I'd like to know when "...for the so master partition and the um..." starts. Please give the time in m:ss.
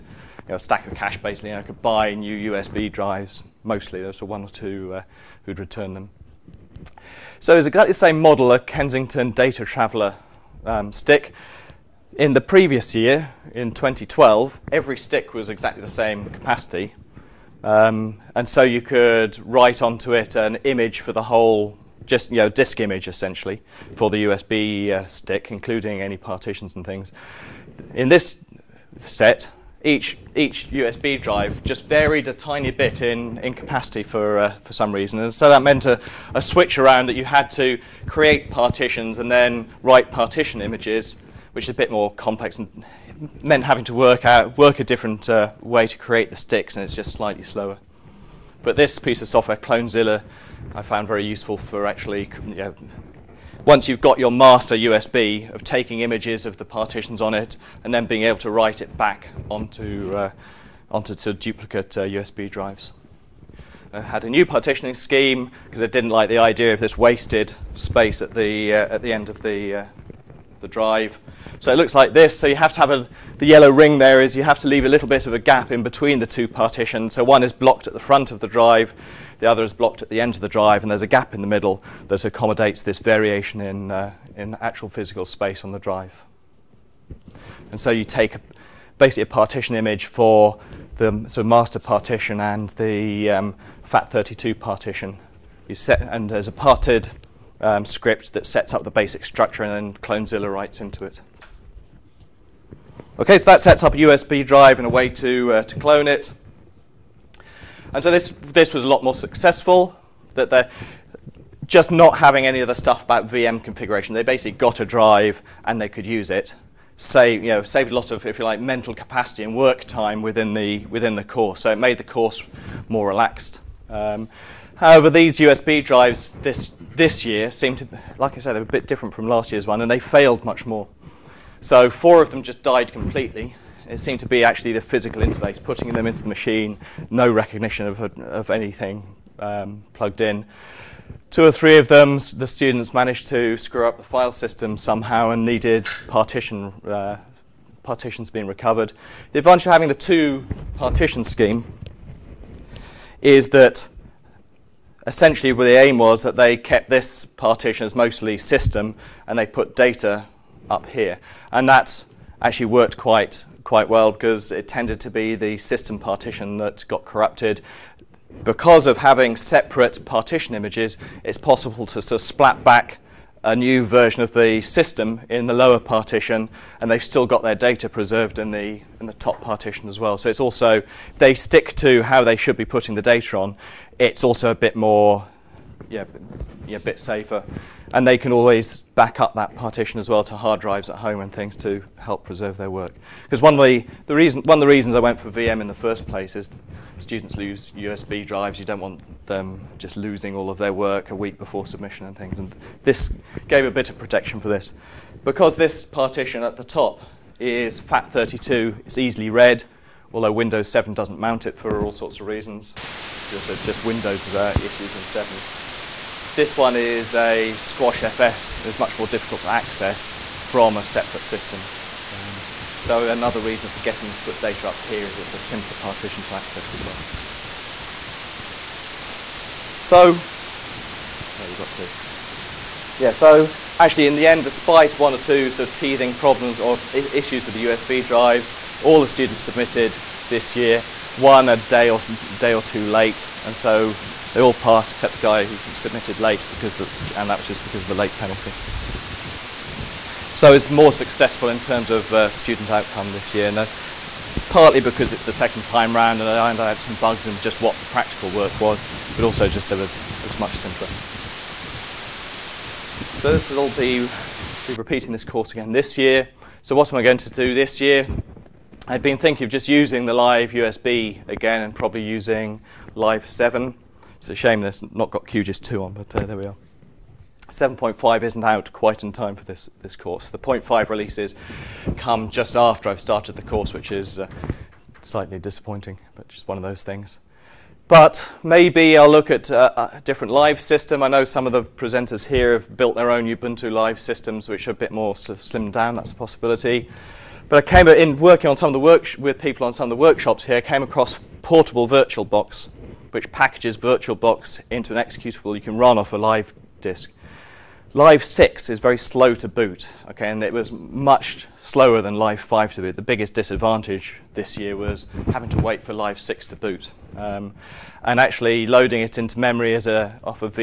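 1:30.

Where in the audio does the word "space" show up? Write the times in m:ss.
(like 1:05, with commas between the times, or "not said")
1:07, 1:25.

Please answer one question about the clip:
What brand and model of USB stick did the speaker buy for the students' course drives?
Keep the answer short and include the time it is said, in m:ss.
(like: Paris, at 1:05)
Kingston DataTraveler, at 0:08.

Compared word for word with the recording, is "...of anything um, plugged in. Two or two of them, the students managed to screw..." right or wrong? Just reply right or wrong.
wrong.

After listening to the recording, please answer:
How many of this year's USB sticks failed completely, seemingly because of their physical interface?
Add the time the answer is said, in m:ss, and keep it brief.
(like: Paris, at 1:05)
4, at 2:11.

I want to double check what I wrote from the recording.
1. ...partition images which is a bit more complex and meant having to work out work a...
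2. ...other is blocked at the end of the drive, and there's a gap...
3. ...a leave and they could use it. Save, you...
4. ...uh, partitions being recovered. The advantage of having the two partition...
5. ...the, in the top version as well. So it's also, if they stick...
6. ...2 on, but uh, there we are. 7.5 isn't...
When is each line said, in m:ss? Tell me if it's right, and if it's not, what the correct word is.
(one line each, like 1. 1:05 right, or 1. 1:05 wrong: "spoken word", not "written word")
1. 0:40 right
2. 1:19 right
3. 1:54 wrong: "drive", not "leave"
4. 2:26 right
5. 2:58 wrong: "partition", not "version"
6. 4:35 right.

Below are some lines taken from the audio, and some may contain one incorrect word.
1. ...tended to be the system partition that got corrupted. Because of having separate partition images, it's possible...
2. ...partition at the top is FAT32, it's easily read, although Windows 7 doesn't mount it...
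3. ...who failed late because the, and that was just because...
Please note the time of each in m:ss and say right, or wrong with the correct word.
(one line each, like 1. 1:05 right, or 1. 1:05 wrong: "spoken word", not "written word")
1. 2:44 right
2. 3:25 right
3. 4:05 wrong: "submitted", not "failed".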